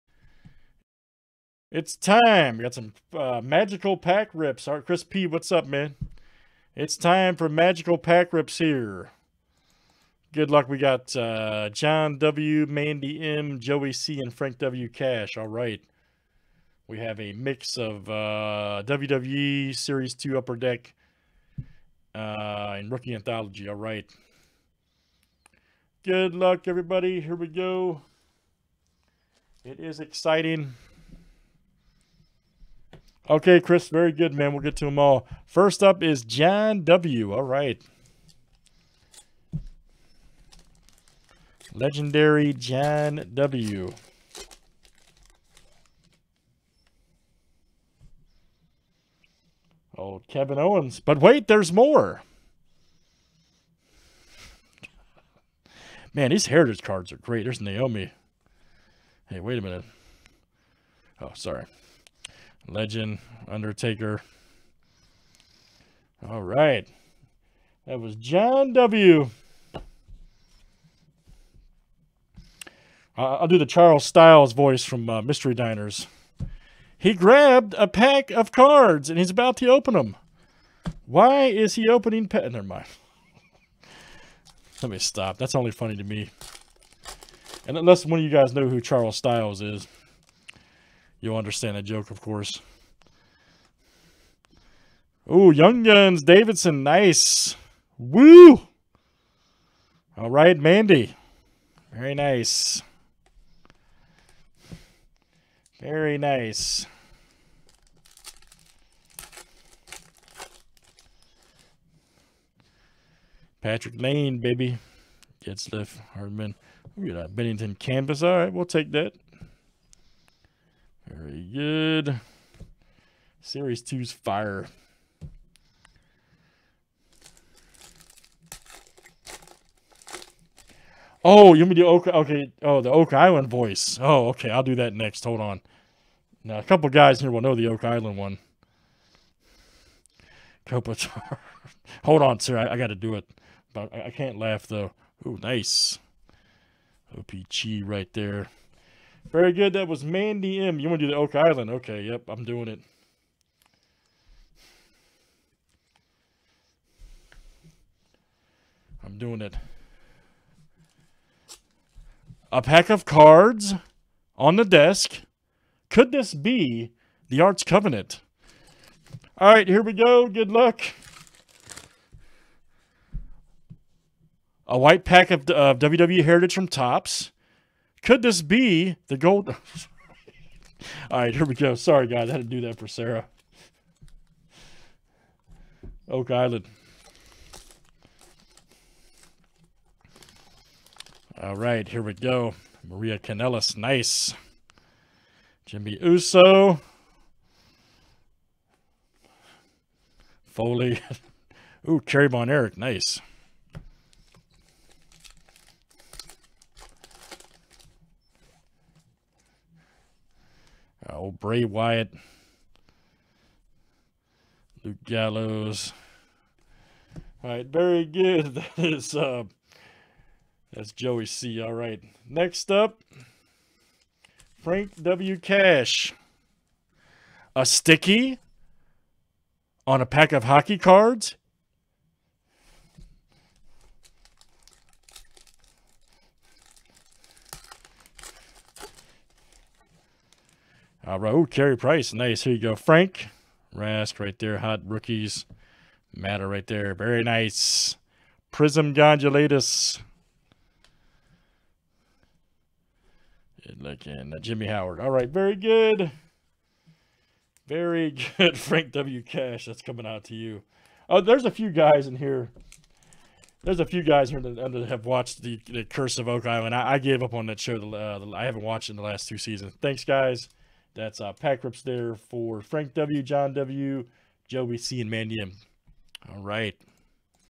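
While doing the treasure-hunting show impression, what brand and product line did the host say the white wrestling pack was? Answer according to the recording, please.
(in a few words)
WWE Heritage from Topps.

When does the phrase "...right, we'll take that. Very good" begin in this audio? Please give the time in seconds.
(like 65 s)
118 s.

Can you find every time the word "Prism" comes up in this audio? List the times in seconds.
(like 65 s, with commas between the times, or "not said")
248 s.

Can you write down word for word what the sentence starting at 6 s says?
It's time for magical pack rips here.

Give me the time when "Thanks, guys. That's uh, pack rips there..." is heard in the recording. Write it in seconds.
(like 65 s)
269 s.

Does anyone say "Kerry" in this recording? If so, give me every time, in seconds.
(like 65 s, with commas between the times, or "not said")
202 s, 241 s.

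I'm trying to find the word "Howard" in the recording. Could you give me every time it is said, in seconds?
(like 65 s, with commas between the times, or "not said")
254 s.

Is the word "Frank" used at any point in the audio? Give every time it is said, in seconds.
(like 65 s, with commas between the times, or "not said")
14 s, 224 s, 242 s, 258 s, 272 s.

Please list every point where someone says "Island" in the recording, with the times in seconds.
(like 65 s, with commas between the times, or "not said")
133 s, 137 s, 151 s, 186 s, 266 s.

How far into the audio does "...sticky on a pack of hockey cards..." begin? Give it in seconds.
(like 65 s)
227 s.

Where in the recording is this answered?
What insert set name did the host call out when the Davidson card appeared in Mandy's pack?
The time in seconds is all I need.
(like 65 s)
95 s.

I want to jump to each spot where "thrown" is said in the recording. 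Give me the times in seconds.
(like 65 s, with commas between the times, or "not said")
not said.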